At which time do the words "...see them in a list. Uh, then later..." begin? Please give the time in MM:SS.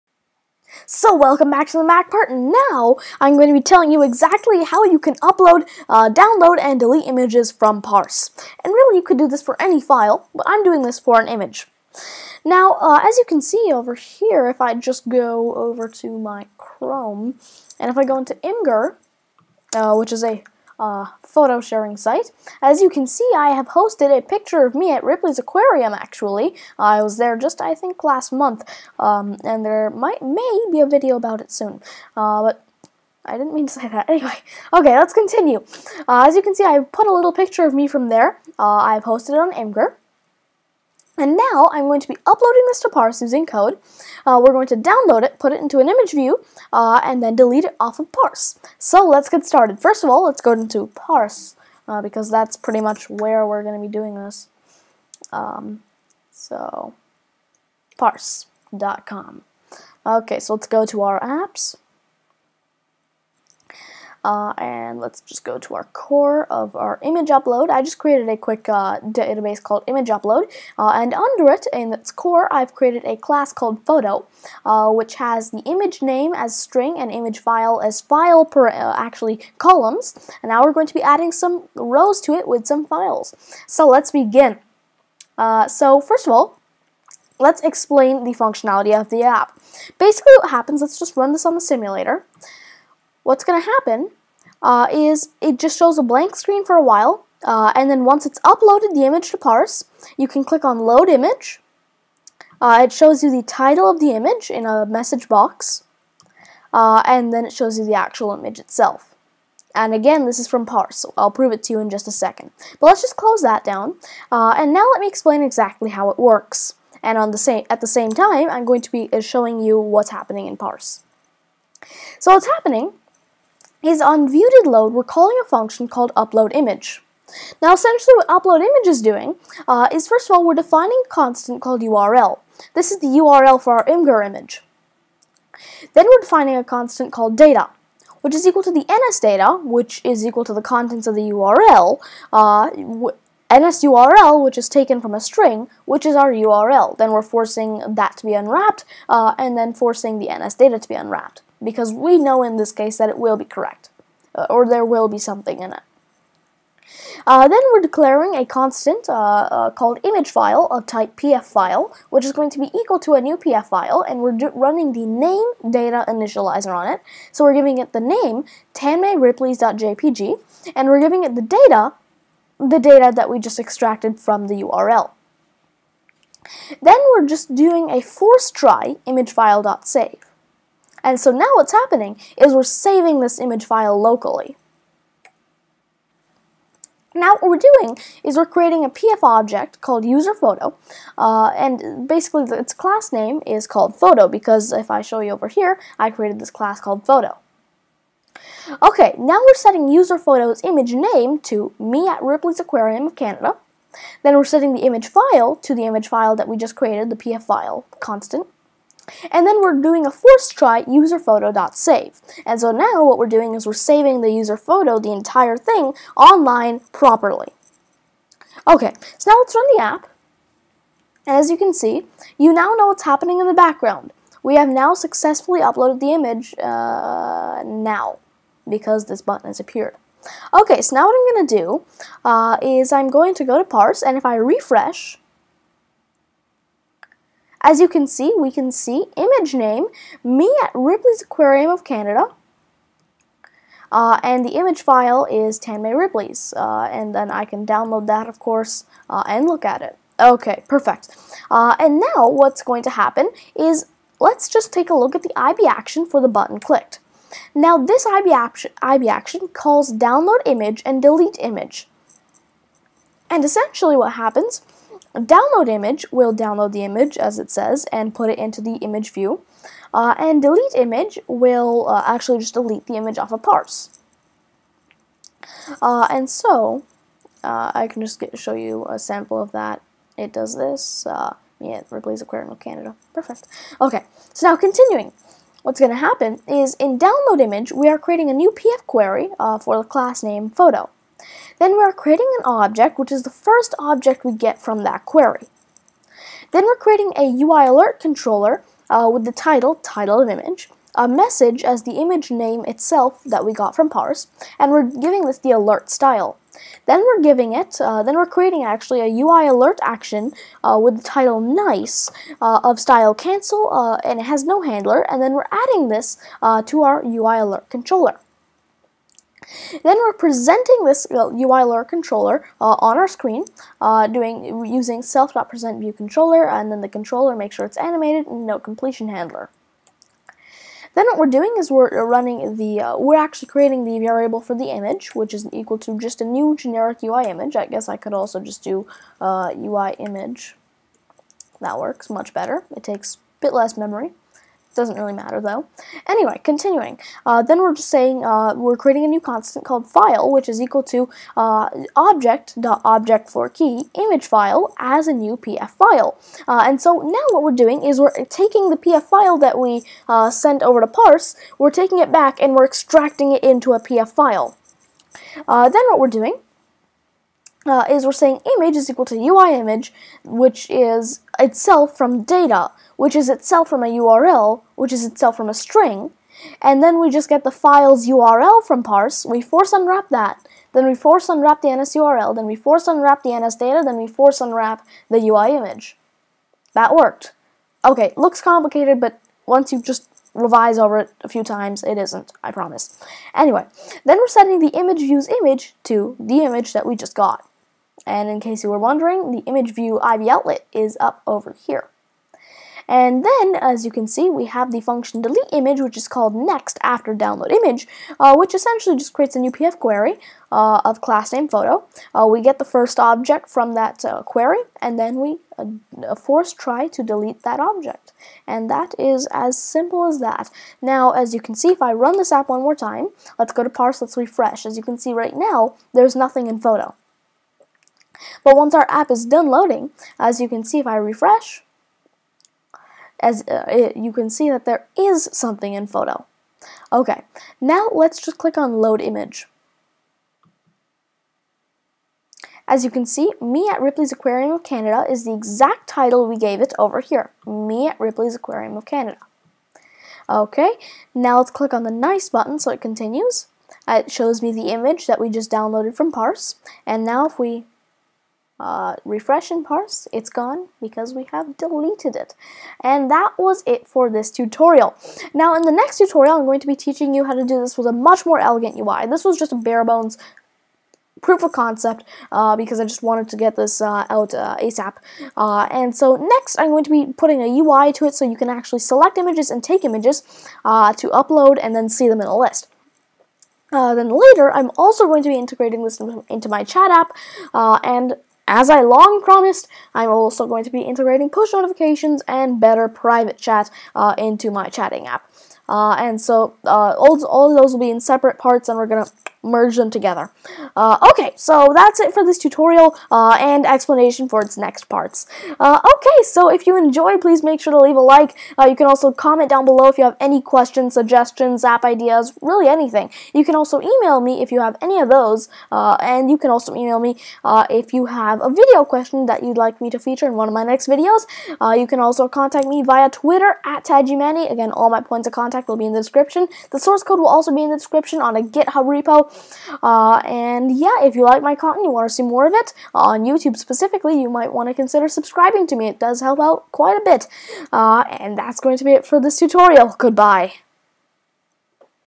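08:01.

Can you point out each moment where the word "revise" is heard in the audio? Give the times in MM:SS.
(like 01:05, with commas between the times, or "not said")
06:30.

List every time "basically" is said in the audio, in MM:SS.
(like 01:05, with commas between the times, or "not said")
01:29, 03:12.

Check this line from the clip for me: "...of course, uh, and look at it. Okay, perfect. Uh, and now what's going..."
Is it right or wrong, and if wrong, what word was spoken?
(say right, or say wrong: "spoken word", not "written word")
right.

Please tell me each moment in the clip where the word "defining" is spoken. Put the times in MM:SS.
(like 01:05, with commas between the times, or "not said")
02:10, 02:16.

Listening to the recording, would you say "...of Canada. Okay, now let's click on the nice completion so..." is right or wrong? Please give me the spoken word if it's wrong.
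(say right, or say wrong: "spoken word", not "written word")
wrong: "button", not "completion".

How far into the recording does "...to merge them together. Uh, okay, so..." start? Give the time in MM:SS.
08:19.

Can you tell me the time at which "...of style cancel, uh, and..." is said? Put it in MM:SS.
05:12.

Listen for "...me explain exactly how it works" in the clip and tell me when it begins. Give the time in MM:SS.
01:55.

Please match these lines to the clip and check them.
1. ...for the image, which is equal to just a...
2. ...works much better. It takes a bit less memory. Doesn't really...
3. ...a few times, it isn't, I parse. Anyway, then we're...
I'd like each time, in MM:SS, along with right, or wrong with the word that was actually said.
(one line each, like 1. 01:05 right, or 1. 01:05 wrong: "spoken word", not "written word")
1. 05:34 right
2. 05:41 right
3. 06:31 wrong: "promise", not "parse".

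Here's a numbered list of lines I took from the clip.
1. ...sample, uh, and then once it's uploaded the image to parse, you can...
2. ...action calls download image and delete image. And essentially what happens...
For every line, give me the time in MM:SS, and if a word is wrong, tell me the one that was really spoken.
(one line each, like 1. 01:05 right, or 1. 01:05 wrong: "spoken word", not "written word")
1. 01:36 wrong: "while", not "sample"
2. 04:19 right.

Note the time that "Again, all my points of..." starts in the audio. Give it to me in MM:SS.
08:44.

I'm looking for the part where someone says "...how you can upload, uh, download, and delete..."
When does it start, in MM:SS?
00:04.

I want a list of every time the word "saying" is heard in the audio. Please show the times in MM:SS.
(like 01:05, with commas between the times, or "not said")
05:47, 06:08.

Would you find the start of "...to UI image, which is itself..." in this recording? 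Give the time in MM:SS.
06:09.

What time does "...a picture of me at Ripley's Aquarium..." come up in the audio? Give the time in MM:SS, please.
00:24.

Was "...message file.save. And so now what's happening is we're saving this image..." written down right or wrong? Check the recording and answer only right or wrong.
wrong.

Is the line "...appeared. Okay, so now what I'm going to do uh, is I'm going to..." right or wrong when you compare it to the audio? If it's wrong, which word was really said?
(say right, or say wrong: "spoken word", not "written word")
right.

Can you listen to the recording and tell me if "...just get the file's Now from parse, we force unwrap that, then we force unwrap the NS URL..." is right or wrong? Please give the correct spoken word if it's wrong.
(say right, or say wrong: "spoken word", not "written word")
wrong: "URL", not "Now".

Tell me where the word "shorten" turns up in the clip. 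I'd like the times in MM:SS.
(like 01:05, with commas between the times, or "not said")
not said.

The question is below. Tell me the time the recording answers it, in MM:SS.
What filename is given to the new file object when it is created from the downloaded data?
02:48.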